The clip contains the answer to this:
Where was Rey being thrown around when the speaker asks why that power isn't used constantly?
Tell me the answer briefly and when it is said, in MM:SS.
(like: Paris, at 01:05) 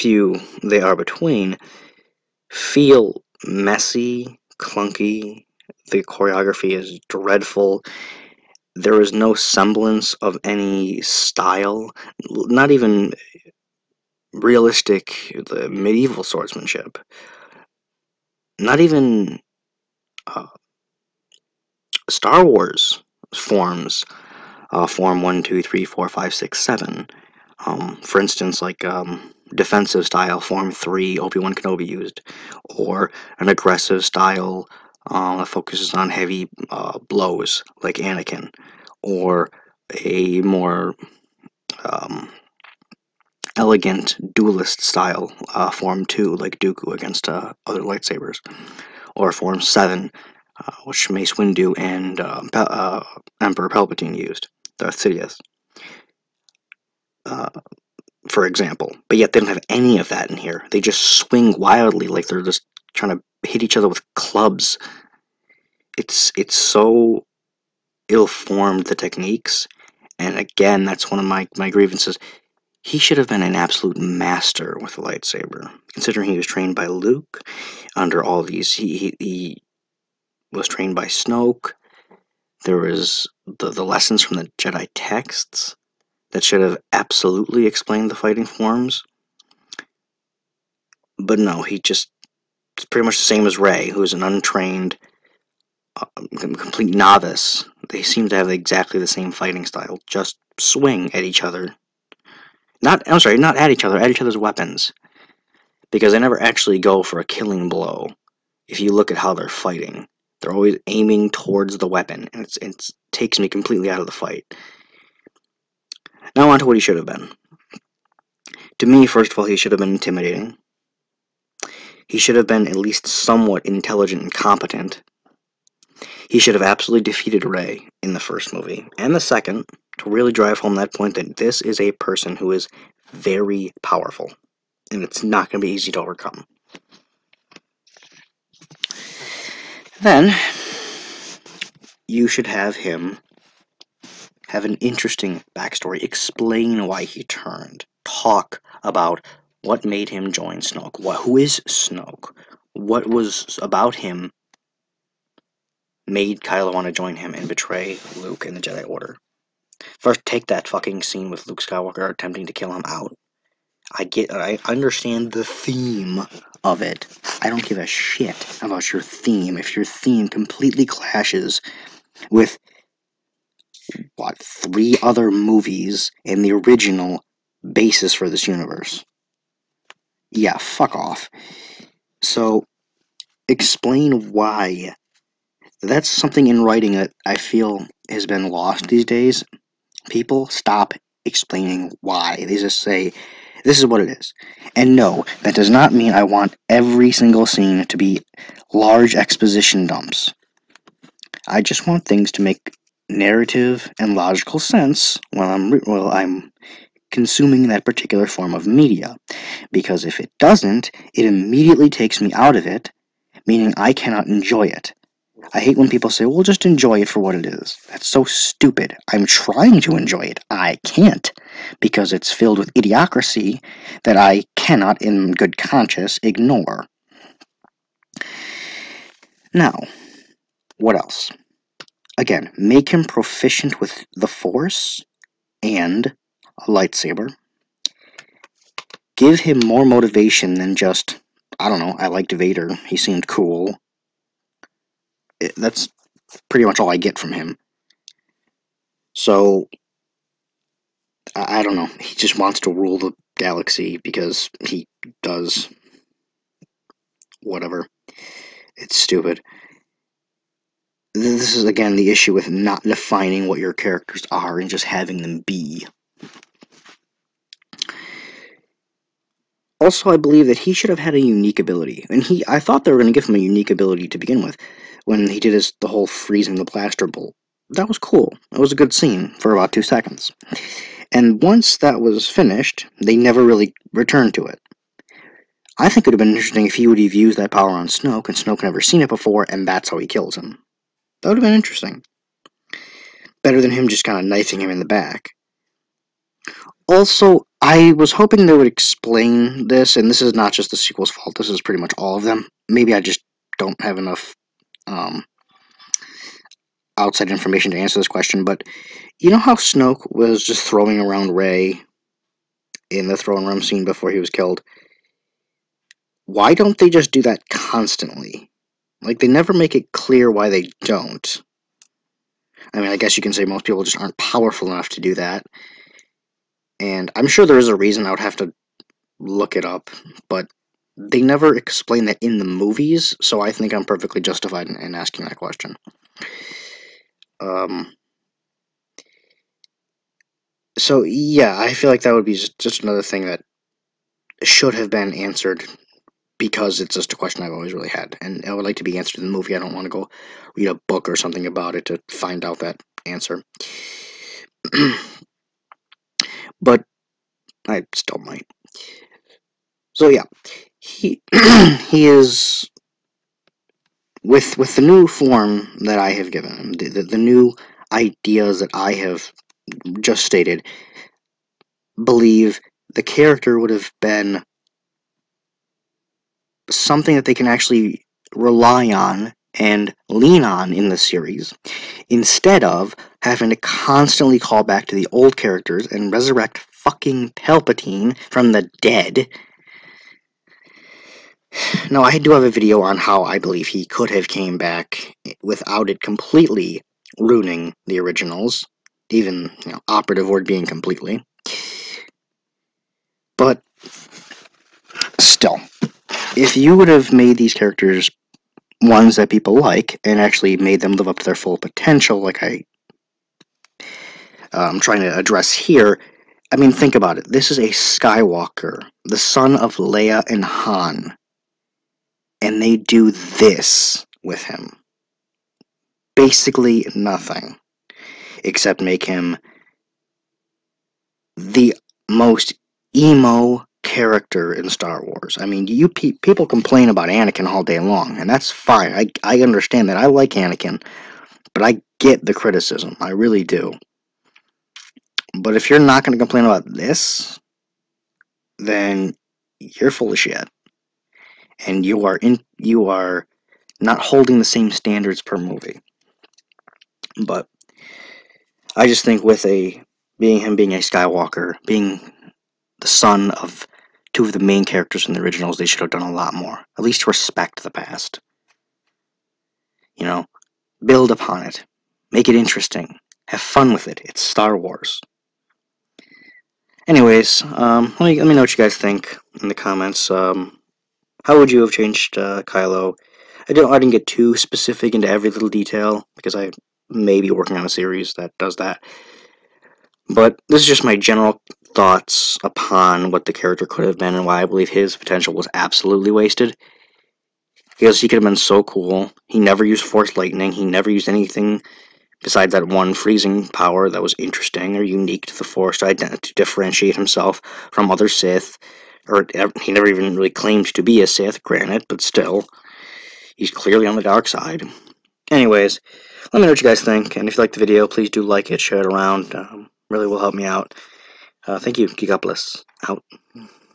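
The throne room, at 05:13.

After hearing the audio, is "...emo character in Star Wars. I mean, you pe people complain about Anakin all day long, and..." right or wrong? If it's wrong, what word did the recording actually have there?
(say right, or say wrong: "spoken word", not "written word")
right.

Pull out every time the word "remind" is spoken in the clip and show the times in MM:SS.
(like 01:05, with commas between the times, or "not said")
not said.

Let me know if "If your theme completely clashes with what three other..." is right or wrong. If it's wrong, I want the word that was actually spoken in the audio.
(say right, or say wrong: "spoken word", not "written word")
right.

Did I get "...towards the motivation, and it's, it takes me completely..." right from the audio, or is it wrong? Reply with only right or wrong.
wrong.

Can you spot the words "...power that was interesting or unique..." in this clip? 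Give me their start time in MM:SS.
08:23.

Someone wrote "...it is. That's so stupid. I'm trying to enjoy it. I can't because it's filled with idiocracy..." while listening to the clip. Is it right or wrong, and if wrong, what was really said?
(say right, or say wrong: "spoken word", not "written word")
right.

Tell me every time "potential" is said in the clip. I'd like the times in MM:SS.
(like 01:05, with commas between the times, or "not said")
06:51, 08:14.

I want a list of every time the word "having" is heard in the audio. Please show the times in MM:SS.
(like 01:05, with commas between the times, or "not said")
04:24, 06:23.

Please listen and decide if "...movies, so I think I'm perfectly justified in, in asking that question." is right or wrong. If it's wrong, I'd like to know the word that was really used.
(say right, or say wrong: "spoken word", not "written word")
right.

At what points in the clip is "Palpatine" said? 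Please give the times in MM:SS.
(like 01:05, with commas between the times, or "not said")
00:53, 06:27.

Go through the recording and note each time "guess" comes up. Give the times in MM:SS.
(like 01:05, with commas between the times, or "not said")
05:22.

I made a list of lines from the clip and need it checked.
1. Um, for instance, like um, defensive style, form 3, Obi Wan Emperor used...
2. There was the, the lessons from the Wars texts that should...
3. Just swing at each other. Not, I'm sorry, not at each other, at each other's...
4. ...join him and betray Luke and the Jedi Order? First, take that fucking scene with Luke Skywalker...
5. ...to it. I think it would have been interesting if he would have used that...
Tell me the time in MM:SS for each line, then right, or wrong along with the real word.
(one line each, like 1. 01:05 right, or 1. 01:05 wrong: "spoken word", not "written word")
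1. 00:27 wrong: "Kenobi", not "Emperor"
2. 01:22 wrong: "Jedi", not "Wars"
3. 01:40 right
4. 02:36 right
5. 04:44 right.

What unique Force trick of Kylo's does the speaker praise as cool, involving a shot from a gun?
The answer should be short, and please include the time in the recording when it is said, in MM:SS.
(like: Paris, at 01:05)
Freezing the blaster bolt, at 04:36.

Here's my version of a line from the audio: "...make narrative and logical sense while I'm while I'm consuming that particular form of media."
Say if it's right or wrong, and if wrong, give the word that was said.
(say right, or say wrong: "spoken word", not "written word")
right.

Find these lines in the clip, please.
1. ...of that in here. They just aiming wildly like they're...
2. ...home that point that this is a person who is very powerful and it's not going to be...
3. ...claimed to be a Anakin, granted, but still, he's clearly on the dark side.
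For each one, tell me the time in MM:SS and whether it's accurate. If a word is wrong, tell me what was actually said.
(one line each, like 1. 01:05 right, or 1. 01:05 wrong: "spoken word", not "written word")
1. 00:59 wrong: "swing", not "aiming"
2. 02:10 right
3. 08:30 wrong: "Sith", not "Anakin".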